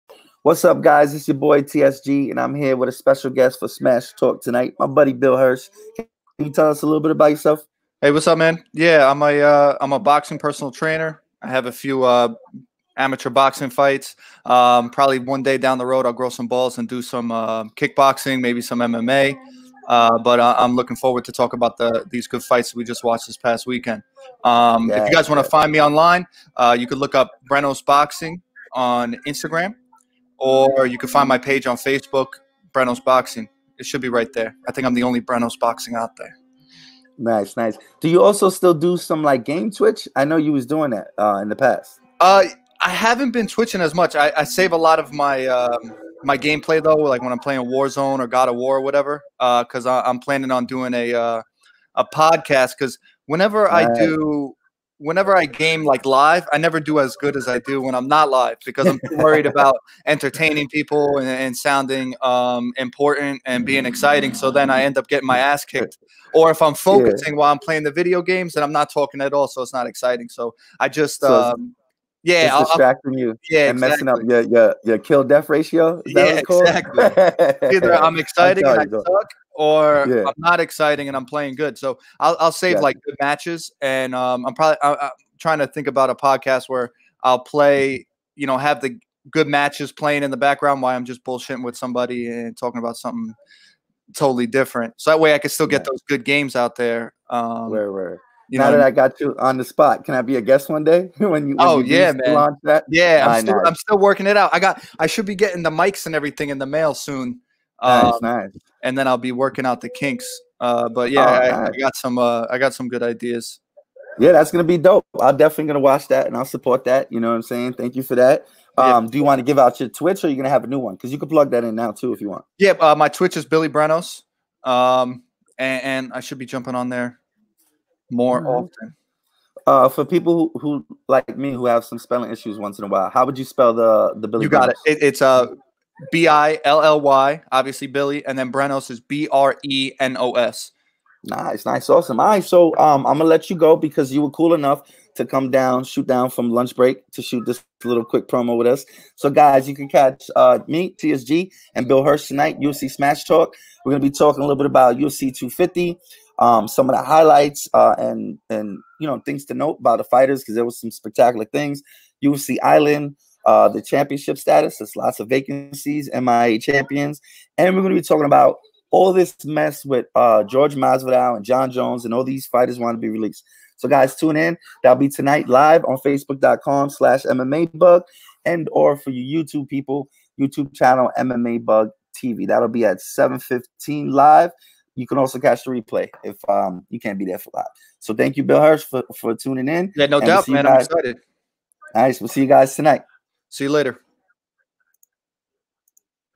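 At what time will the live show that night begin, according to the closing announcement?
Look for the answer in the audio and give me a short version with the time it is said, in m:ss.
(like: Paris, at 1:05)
7:15, at 3:02.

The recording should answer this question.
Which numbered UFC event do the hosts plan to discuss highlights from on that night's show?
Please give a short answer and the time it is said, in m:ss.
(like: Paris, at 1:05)
UFC 250, at 2:34.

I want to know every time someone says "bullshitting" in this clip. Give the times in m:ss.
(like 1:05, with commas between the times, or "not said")
1:31.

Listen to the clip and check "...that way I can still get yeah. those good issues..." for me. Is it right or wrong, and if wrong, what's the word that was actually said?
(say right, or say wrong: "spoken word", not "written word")
wrong: "games", not "issues".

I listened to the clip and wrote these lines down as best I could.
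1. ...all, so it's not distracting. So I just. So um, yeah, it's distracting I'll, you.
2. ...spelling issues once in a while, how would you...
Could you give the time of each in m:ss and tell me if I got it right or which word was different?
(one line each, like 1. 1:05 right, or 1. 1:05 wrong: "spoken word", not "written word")
1. 1:09 wrong: "exciting", not "distracting"
2. 2:11 right.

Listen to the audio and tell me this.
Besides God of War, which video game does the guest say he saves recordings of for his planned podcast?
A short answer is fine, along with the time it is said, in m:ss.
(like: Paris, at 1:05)
Warzone, at 0:47.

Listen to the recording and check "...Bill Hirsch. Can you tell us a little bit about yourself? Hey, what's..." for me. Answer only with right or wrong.
right.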